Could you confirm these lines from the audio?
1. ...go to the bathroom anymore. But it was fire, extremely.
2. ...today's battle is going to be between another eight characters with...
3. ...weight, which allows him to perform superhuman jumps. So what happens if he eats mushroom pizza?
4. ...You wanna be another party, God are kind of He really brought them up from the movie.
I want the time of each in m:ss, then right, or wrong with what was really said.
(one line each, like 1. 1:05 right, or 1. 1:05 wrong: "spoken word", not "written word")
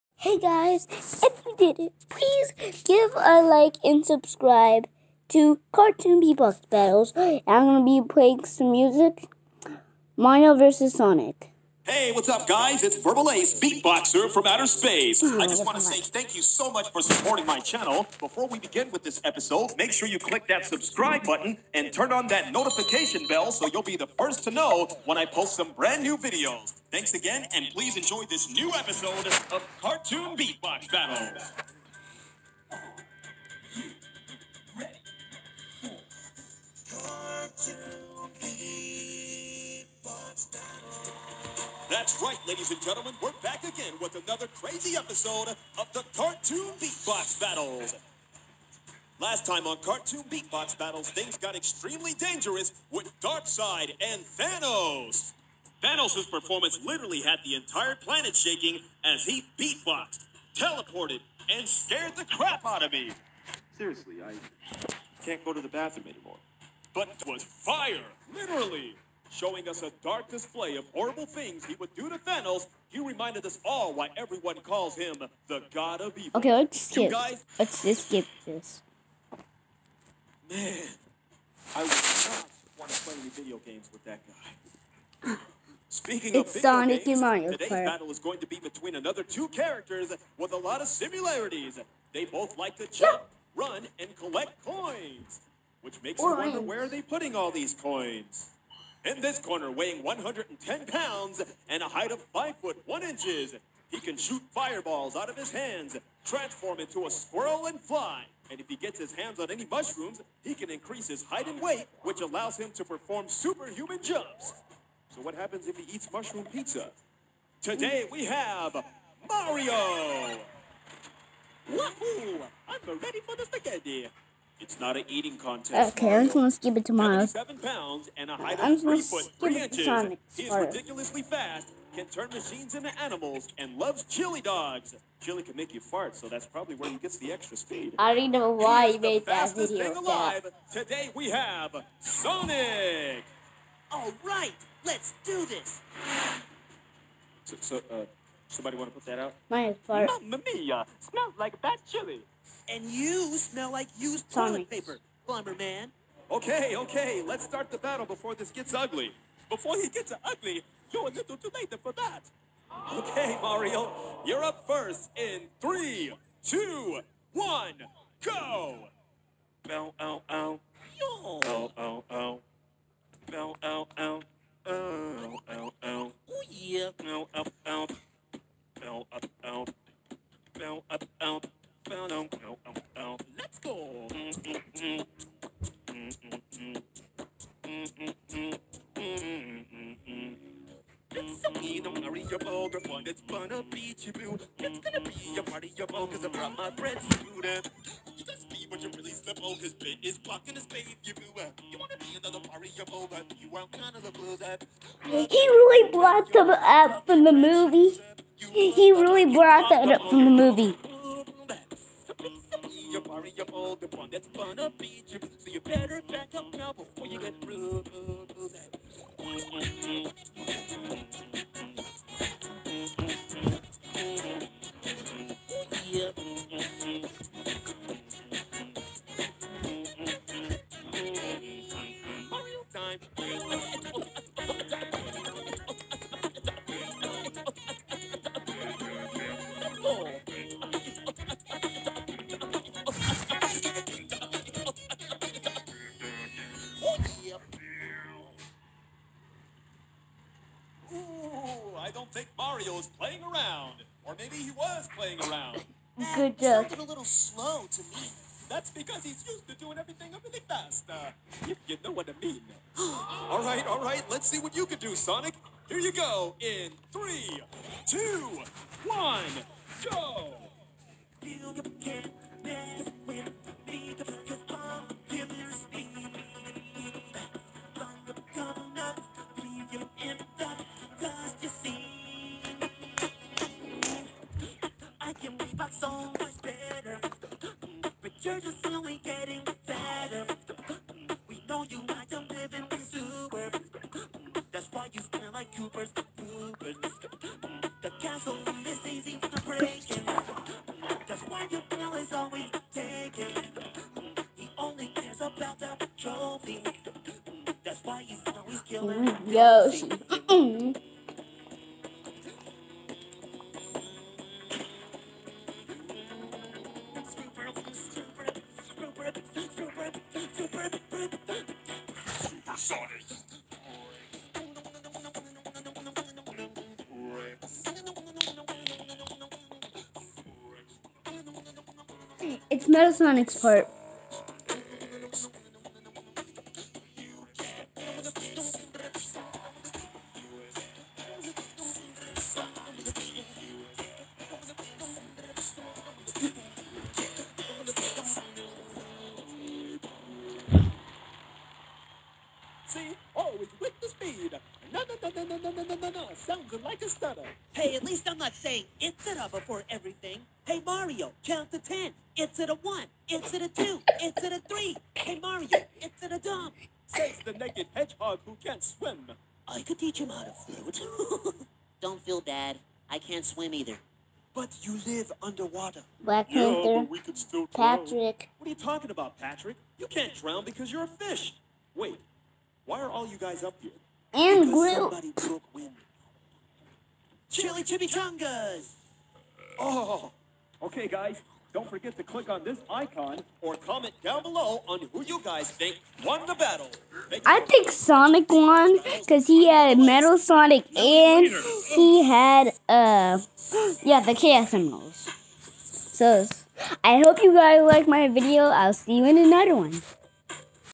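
1. 1:05 wrong: "literally", not "extremely"
2. 1:27 wrong: "two", not "eight"
3. 1:51 right
4. 3:21 wrong: "You", not "God".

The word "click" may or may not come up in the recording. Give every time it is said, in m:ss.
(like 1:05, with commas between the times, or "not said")
0:20, 6:32.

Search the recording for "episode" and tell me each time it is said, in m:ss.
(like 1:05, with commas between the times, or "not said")
0:19, 0:28, 0:44.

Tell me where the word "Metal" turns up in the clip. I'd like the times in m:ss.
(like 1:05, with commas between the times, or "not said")
5:32, 6:39.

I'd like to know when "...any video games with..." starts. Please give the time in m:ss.
1:23.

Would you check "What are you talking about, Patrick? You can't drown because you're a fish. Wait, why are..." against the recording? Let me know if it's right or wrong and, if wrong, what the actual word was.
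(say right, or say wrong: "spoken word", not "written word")
right.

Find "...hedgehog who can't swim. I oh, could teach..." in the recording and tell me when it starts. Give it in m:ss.
6:07.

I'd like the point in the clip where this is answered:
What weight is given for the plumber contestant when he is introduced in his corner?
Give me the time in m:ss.
1:40.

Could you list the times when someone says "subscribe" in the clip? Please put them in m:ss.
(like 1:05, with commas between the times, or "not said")
0:04, 0:20.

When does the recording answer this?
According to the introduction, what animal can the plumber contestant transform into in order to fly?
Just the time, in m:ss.
1:47.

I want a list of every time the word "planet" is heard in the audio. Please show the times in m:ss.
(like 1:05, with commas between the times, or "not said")
0:57.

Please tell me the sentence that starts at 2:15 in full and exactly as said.
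Chili can make you fart, so that's probably where he gets the extra speed.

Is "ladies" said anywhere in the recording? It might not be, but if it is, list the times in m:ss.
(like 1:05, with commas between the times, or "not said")
0:42.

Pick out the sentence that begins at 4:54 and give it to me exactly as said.
That's why you smell like Cooper's the Ubers.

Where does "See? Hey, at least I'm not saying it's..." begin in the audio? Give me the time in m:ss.
5:56.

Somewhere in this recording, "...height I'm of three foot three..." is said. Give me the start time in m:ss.
2:08.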